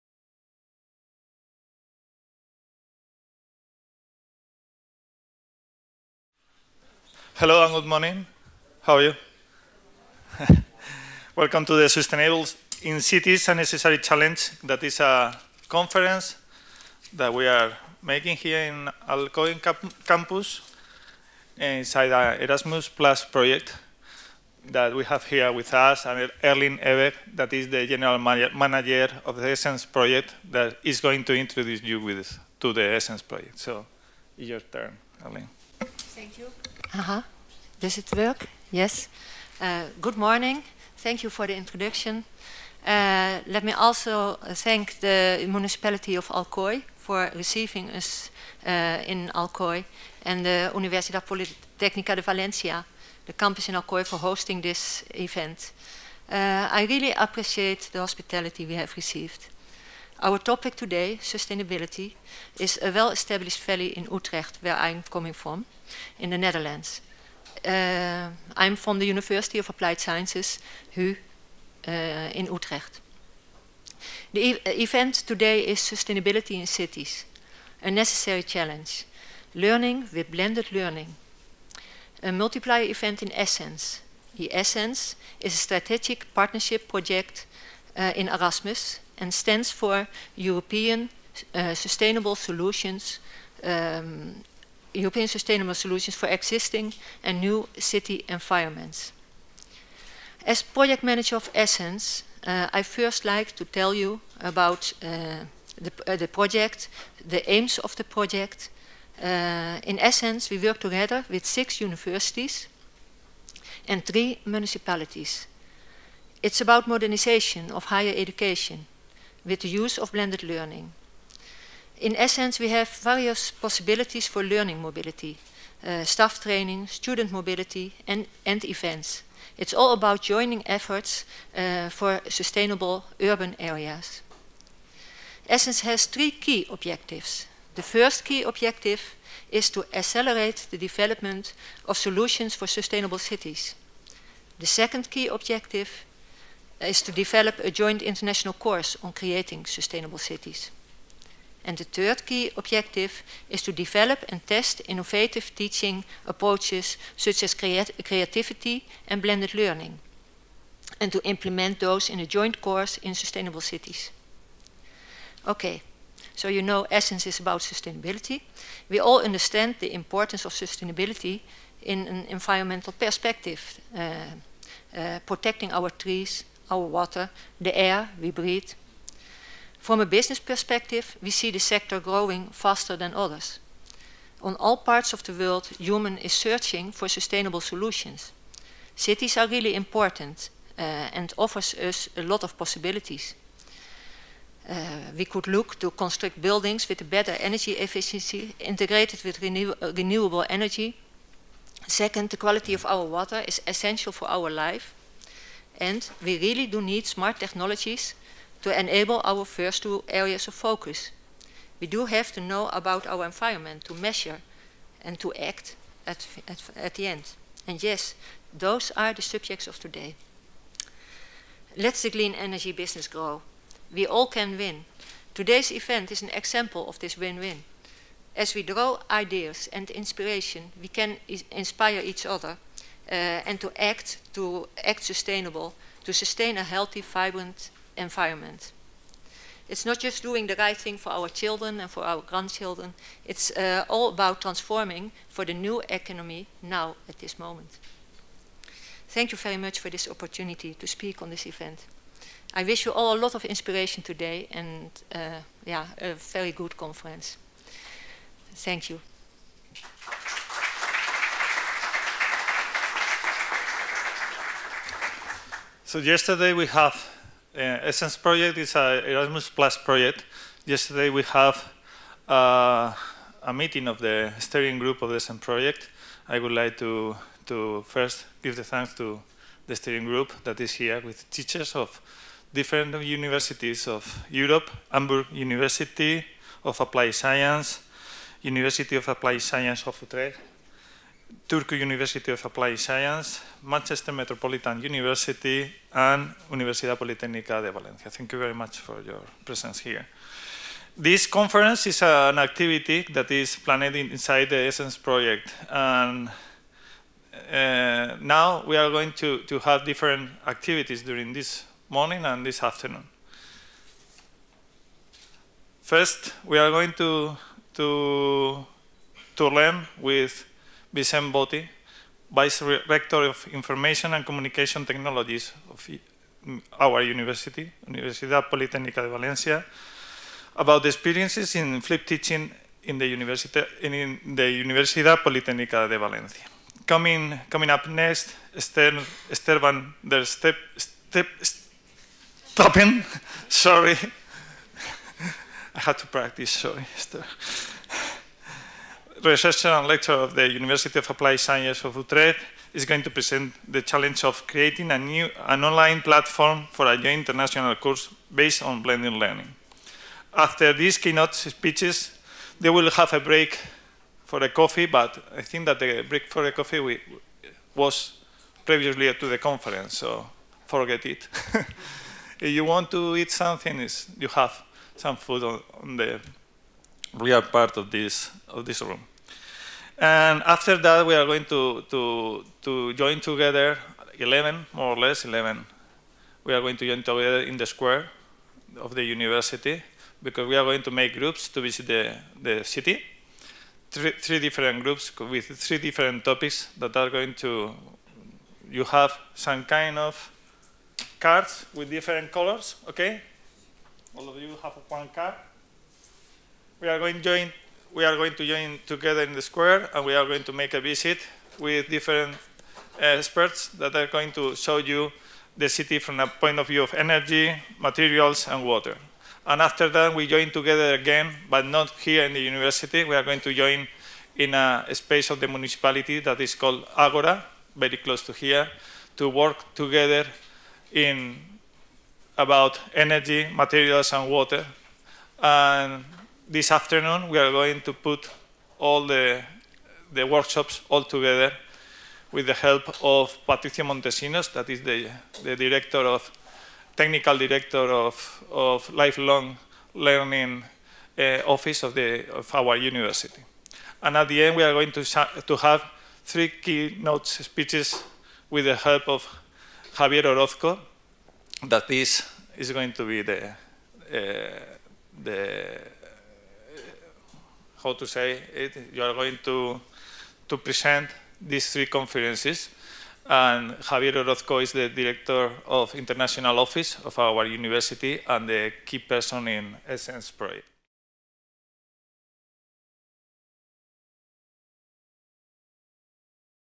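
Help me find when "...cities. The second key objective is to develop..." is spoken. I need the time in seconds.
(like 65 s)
143 s.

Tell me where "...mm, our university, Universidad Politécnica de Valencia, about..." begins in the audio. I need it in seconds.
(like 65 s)
326 s.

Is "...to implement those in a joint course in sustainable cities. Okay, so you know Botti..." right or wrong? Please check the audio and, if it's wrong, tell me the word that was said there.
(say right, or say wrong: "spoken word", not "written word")
wrong: "Essence", not "Botti".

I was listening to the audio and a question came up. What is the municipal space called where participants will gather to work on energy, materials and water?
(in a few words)
Agora.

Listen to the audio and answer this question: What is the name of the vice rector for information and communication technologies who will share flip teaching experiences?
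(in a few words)
Vicent Botti.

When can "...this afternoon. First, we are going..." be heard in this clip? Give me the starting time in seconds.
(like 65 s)
312 s.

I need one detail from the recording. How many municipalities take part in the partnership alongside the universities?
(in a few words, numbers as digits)
3.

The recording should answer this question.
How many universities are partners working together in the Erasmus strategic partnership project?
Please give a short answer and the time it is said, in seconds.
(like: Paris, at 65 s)
6, at 111 s.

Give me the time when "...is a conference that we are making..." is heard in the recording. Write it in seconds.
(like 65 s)
14 s.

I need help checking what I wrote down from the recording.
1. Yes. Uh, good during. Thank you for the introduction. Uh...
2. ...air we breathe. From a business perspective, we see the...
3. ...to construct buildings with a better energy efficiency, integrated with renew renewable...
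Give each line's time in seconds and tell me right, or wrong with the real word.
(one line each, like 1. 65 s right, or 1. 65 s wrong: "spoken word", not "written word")
1. 38 s wrong: "morning", not "during"
2. 177 s right
3. 195 s right.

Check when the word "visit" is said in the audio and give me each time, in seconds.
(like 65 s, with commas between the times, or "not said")
391 s, 410 s.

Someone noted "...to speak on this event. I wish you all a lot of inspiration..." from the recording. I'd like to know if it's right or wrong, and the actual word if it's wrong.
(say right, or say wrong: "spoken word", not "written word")
right.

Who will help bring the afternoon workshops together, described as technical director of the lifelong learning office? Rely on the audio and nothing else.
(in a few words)
Patricio Montesinos.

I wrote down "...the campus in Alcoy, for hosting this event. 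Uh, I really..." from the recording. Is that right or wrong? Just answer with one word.
right.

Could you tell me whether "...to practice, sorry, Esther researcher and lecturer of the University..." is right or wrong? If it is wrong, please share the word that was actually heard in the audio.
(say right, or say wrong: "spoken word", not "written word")
right.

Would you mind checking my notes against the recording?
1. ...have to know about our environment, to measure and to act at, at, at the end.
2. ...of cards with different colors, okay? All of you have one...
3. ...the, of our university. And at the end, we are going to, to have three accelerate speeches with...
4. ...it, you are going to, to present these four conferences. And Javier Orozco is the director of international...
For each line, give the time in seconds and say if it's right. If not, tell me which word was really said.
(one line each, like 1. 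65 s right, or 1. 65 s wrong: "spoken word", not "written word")
1. 212 s right
2. 399 s right
3. 451 s wrong: "keynote", not "accelerate"
4. 468 s wrong: "three", not "four".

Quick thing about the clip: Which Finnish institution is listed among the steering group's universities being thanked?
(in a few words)
Turku University of Applied Science.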